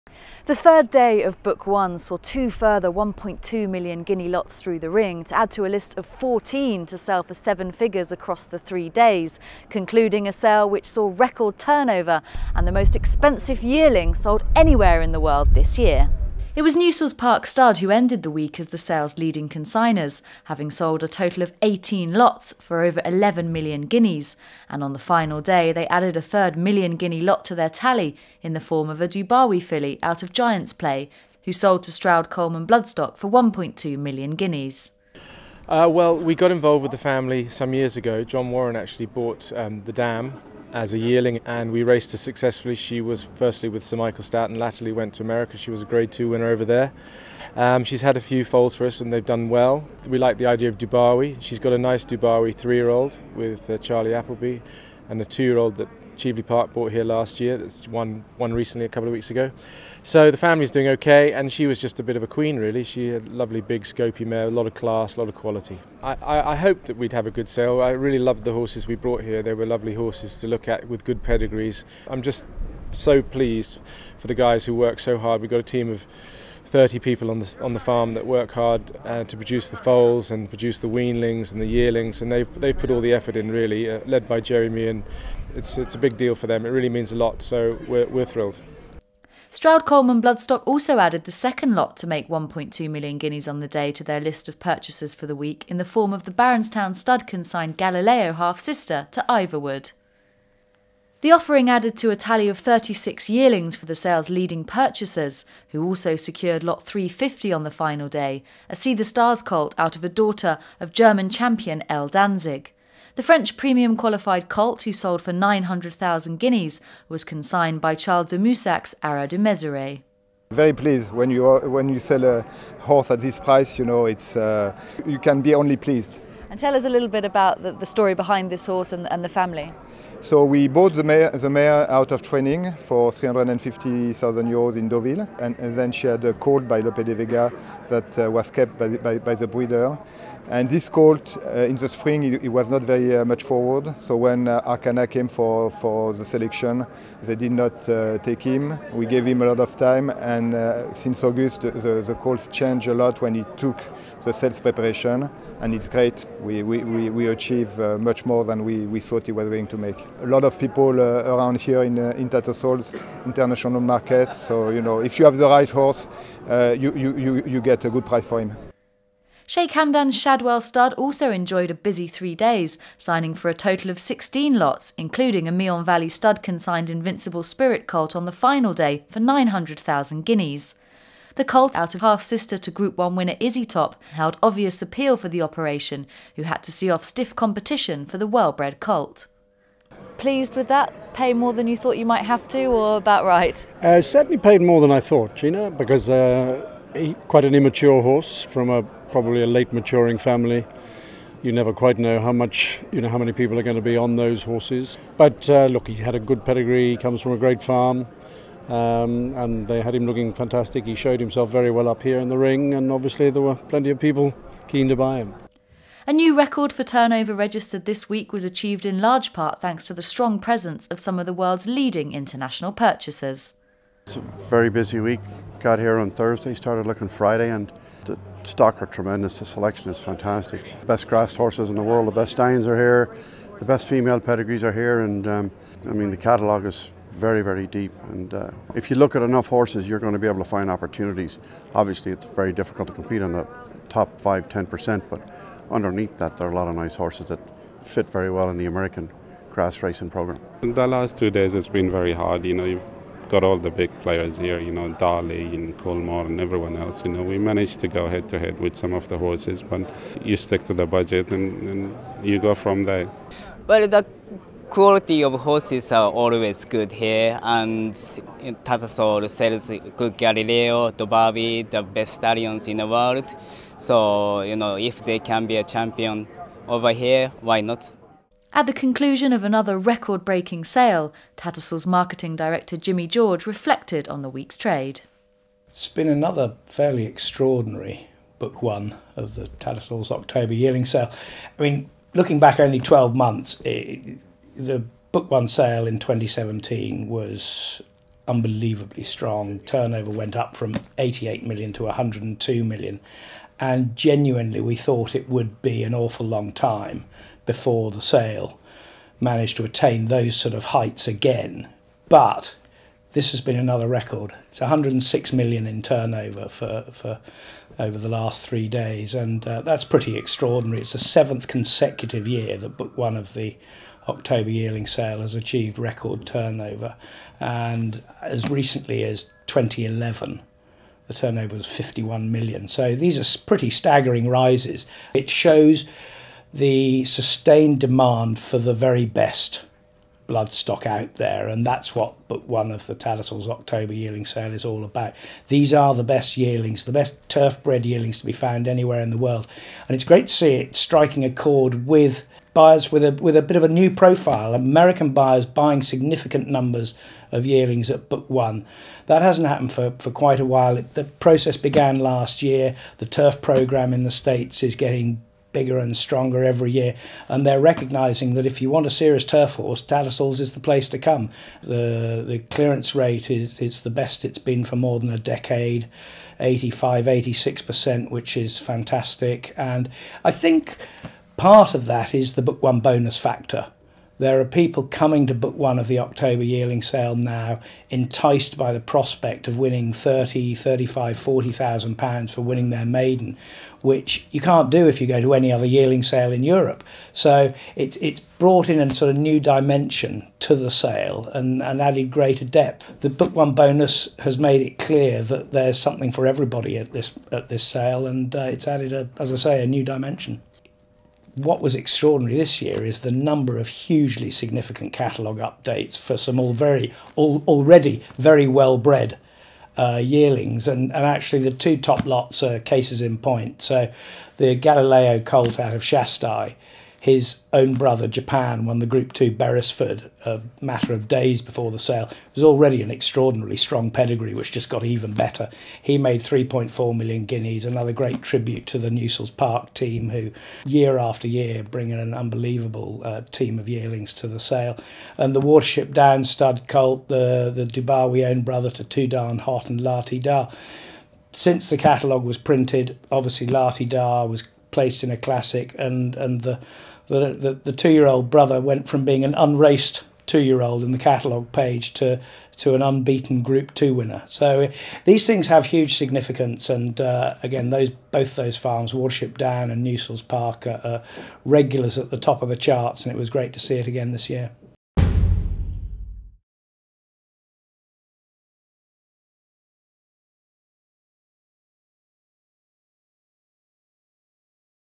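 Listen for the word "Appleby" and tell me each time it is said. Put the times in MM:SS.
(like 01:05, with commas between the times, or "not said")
00:54.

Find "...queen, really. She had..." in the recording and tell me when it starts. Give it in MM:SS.
01:02.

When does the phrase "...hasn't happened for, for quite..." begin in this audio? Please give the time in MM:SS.
05:59.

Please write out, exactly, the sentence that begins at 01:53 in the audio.
The French premium qualified colt, who sold for 900,000 guineas, was consigned by Charles de Moussac's Haras de Mézeray.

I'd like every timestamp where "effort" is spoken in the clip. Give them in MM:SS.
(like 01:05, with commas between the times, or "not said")
01:23.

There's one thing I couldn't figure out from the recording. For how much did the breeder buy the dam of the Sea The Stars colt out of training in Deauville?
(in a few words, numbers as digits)
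350,000 euros.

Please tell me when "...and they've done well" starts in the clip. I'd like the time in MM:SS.
00:49.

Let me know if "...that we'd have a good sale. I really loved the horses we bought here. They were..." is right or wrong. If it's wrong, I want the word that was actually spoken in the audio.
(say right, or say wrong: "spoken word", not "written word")
wrong: "brought", not "bought".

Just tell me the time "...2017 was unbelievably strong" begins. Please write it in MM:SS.
04:55.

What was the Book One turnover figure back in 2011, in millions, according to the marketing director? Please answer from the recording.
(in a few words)
51 million.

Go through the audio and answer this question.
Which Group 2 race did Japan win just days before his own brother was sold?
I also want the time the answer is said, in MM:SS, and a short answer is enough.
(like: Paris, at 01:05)
Beresford, at 07:09.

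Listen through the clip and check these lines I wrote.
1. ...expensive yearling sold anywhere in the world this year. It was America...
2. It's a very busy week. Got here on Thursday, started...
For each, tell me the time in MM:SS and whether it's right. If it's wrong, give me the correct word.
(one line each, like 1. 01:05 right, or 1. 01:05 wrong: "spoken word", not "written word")
1. 00:12 wrong: "Newsells", not "America"
2. 03:44 right.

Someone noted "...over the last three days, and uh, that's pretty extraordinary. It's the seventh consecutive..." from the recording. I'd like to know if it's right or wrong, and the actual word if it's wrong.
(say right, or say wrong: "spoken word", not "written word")
right.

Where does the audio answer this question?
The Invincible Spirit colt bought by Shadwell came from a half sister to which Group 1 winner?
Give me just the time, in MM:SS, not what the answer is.
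03:03.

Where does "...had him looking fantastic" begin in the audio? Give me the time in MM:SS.
03:29.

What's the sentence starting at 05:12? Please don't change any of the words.
But this has been another record.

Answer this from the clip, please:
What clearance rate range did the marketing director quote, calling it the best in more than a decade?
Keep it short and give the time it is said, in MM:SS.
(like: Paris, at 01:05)
85-86%, at 06:16.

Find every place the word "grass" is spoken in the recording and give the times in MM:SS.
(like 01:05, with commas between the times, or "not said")
03:51, 04:09.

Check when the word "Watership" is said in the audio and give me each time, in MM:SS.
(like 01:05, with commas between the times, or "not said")
07:25, 07:48.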